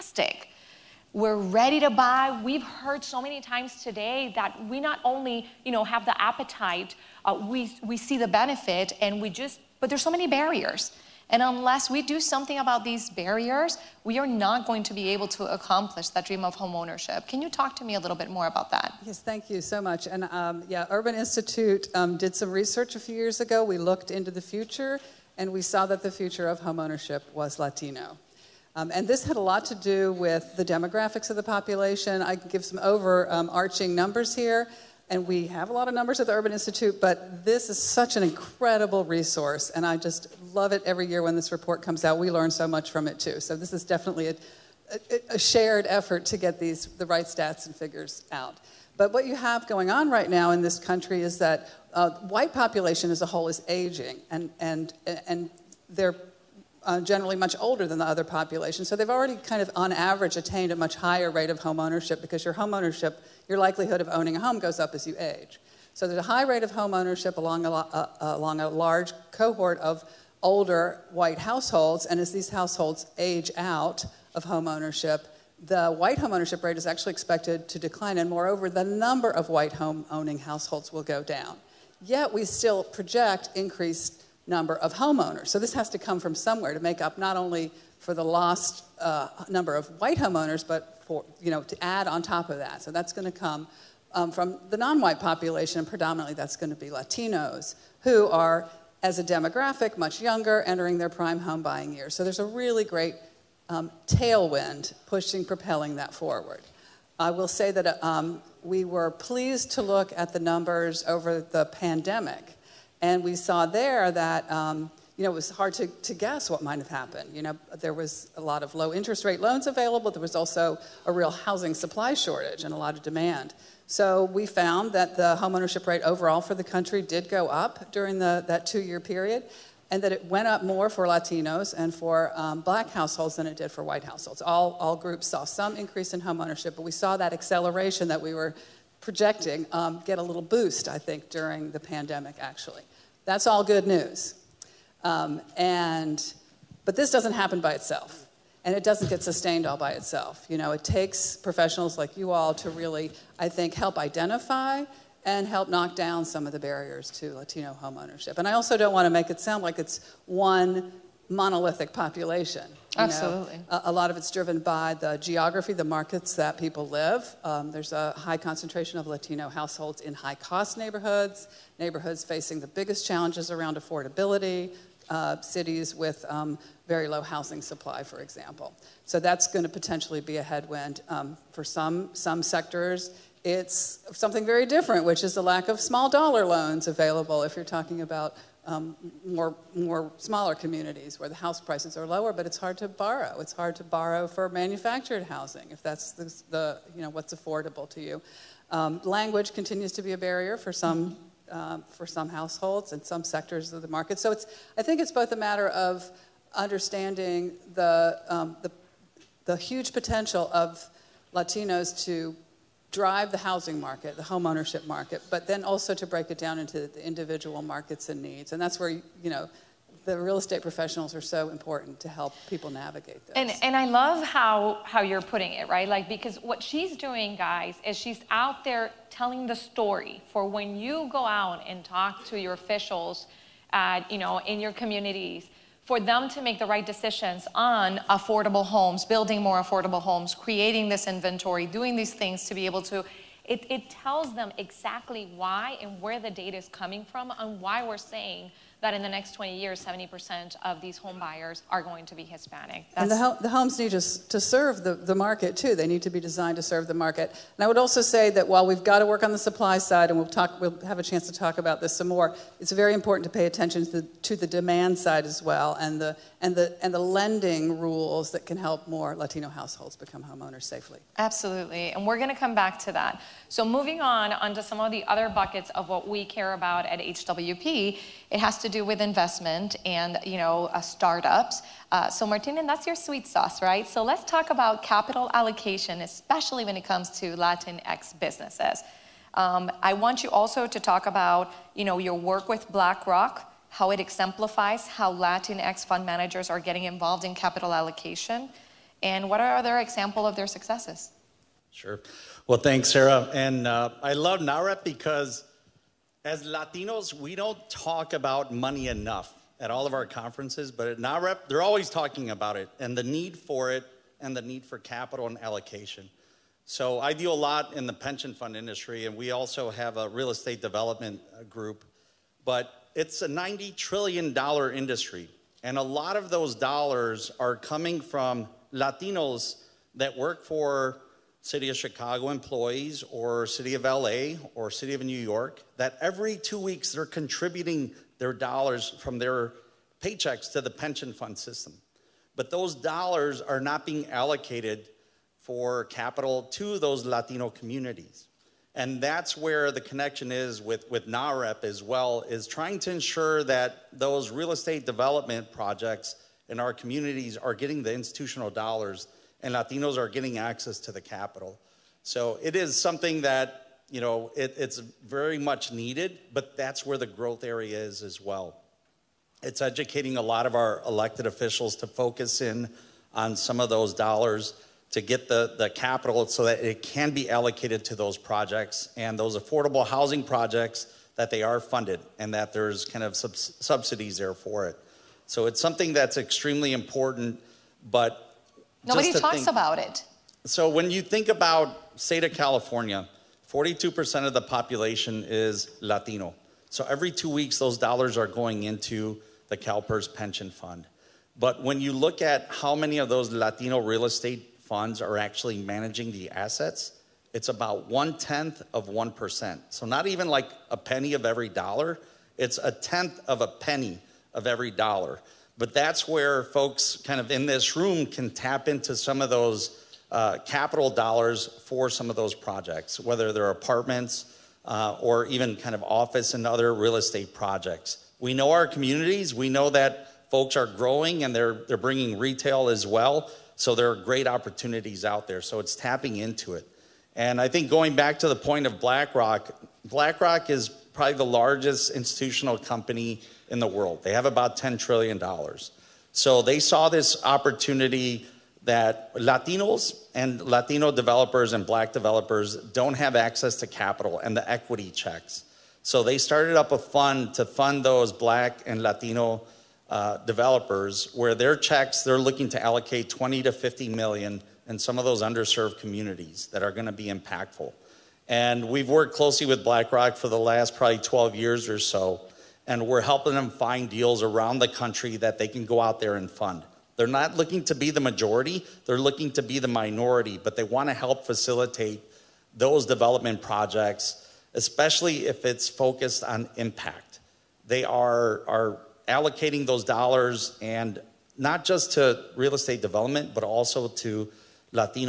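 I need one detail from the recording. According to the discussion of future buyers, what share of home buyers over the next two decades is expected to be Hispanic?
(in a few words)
70%.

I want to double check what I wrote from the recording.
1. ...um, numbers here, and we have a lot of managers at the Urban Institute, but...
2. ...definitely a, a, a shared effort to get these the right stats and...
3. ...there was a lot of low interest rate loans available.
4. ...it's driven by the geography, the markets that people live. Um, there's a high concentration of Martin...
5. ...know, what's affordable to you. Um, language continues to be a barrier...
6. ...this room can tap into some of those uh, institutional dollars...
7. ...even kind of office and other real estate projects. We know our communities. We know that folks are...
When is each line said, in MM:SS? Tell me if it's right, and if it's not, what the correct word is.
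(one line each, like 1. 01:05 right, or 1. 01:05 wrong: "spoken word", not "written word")
1. 00:33 wrong: "numbers", not "managers"
2. 00:43 right
3. 01:57 right
4. 02:44 wrong: "Latino", not "Martin"
5. 03:17 right
6. 06:57 wrong: "capital", not "institutional"
7. 07:05 right.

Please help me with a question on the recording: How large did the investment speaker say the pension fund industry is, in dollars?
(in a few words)
$90 trillion.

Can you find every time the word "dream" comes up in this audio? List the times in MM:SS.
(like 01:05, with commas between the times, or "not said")
00:16.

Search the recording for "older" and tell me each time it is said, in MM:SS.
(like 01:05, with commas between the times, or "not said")
00:57, 01:10.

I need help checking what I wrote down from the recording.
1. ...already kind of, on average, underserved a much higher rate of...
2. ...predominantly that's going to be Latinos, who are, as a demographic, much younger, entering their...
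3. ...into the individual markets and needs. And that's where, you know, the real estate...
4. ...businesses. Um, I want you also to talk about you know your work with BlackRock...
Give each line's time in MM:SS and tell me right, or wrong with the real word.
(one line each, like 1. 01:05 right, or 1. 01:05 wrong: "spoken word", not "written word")
1. 00:59 wrong: "attained", not "underserved"
2. 01:35 right
3. 03:36 right
4. 04:48 right.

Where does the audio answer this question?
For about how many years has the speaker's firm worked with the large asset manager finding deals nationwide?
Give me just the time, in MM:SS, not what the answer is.
07:50.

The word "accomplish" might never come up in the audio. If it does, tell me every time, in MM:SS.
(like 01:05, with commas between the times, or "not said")
00:15.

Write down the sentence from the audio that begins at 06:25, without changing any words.
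So it's something that's extremely important, but Nobody talks think.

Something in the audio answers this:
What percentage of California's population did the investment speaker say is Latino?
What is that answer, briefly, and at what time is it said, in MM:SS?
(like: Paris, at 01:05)
42%, at 06:33.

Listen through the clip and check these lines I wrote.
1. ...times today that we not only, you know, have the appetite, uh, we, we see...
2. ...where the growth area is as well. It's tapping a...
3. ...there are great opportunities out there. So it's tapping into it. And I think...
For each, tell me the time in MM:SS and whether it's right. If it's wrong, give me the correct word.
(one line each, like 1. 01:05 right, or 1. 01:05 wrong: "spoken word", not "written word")
1. 00:03 right
2. 06:06 wrong: "educating", not "tapping"
3. 07:13 right.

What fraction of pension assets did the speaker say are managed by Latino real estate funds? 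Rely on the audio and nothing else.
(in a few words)
one tenth of 1%.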